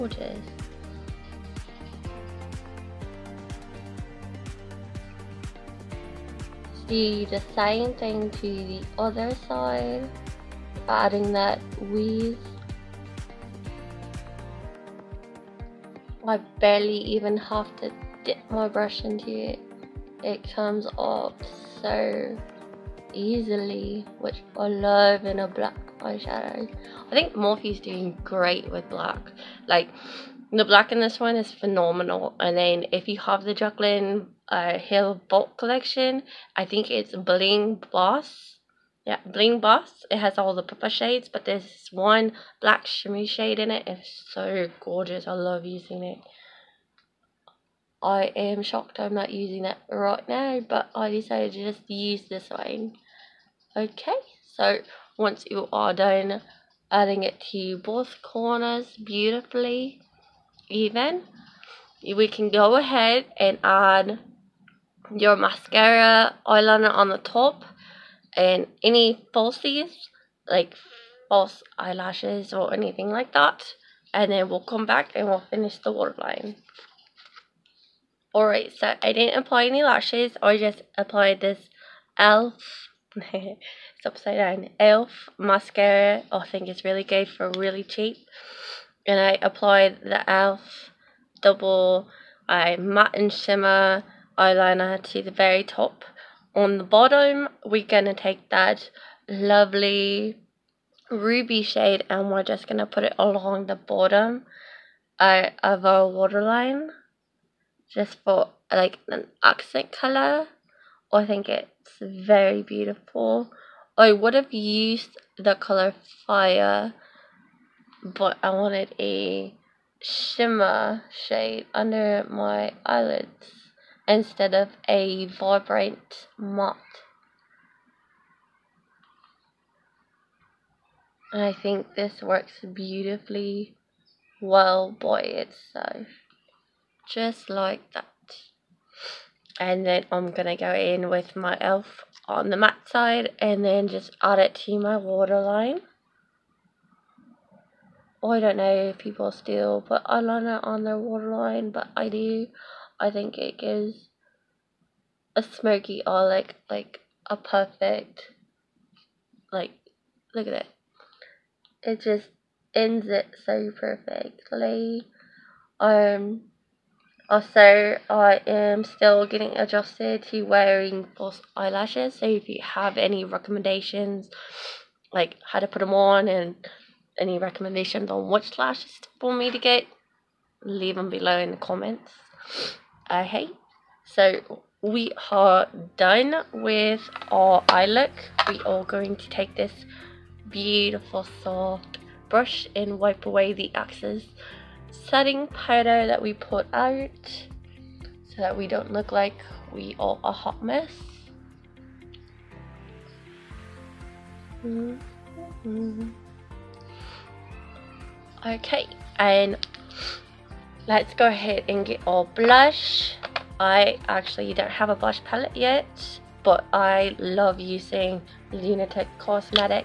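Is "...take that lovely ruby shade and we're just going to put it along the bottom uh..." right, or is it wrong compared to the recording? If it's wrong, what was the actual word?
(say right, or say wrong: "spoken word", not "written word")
right.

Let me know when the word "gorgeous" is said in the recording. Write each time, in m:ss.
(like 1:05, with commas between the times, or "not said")
0:44.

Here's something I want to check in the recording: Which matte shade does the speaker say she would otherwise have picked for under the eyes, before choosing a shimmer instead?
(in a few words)
Fire.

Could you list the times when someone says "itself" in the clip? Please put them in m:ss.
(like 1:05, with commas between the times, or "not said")
2:15.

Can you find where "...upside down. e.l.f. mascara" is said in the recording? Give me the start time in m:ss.
1:24.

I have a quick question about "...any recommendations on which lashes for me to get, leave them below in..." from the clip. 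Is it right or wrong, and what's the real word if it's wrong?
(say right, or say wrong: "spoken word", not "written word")
right.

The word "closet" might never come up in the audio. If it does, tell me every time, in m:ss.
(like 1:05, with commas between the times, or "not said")
not said.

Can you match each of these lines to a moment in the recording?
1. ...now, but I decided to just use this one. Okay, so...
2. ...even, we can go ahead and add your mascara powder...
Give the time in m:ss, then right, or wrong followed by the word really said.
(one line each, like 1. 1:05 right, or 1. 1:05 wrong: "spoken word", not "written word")
1. 0:50 right
2. 1:00 wrong: "eyeliner", not "powder".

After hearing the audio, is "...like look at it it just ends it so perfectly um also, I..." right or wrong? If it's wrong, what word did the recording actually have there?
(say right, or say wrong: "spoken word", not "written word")
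right.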